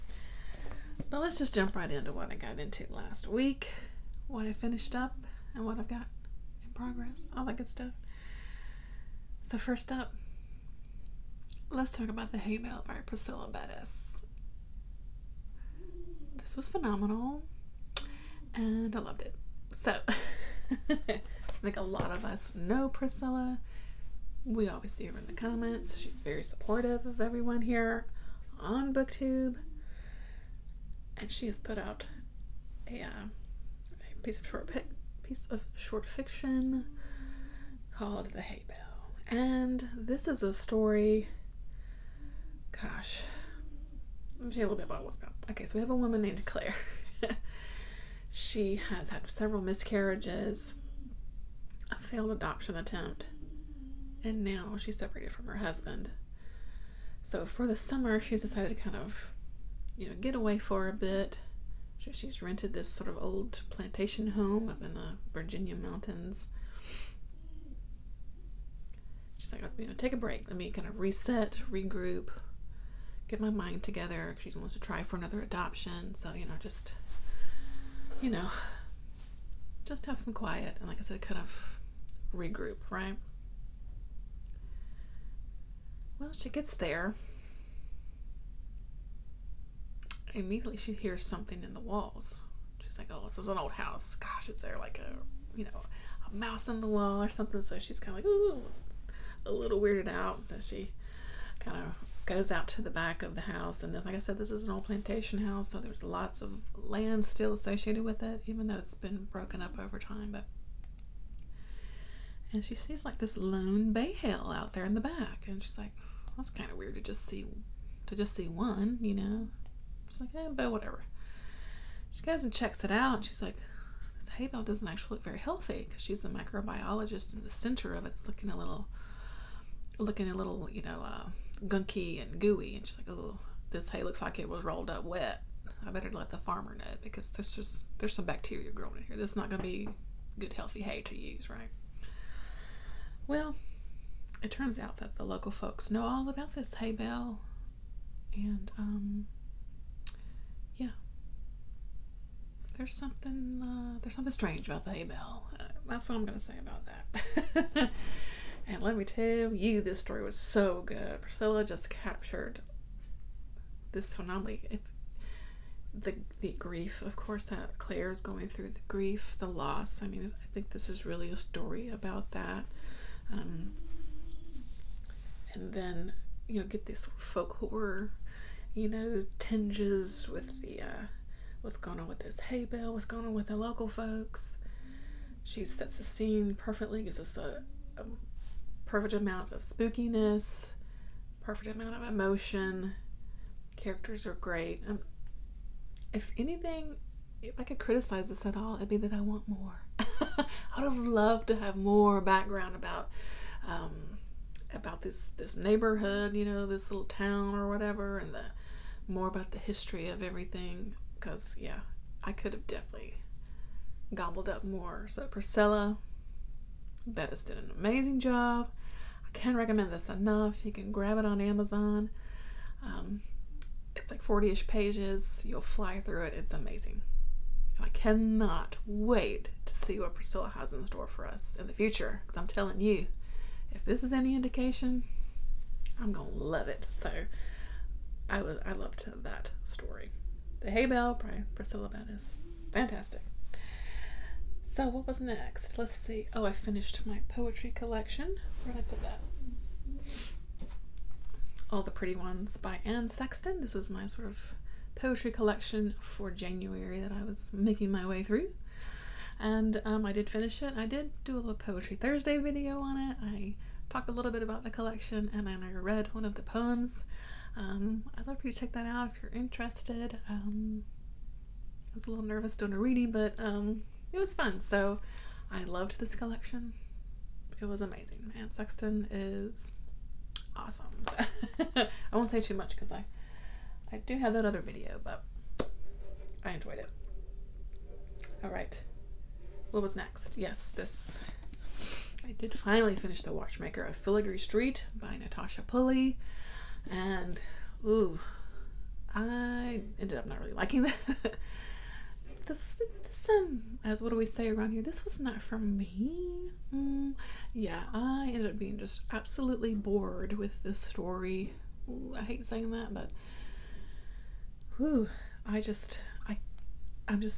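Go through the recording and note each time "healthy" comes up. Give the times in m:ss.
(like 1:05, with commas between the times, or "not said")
2:05, 2:20.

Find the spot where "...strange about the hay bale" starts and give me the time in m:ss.
2:34.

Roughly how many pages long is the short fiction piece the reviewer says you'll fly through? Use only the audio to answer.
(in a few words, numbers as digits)
40.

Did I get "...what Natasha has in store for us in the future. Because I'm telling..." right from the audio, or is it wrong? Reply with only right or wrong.
wrong.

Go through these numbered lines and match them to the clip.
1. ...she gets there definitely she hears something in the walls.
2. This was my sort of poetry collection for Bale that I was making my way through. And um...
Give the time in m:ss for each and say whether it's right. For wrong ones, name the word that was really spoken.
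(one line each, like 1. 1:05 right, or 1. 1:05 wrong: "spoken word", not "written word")
1. 1:26 wrong: "immediately", not "definitely"
2. 4:13 wrong: "January", not "Bale".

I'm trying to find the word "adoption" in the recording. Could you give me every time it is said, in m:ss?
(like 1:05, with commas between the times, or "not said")
0:52, 1:15.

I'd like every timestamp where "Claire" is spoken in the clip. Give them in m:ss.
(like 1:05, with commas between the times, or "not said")
0:46, 2:47.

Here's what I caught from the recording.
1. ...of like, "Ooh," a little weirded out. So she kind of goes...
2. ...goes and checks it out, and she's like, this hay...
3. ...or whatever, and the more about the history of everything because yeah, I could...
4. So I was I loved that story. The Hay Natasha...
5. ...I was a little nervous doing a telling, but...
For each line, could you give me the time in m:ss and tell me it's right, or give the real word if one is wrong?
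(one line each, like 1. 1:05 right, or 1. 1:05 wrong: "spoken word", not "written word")
1. 1:38 right
2. 2:02 right
3. 3:27 right
4. 3:56 wrong: "Bale", not "Natasha"
5. 4:31 wrong: "reading", not "telling".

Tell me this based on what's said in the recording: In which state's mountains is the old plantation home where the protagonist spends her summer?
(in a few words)
Virginia.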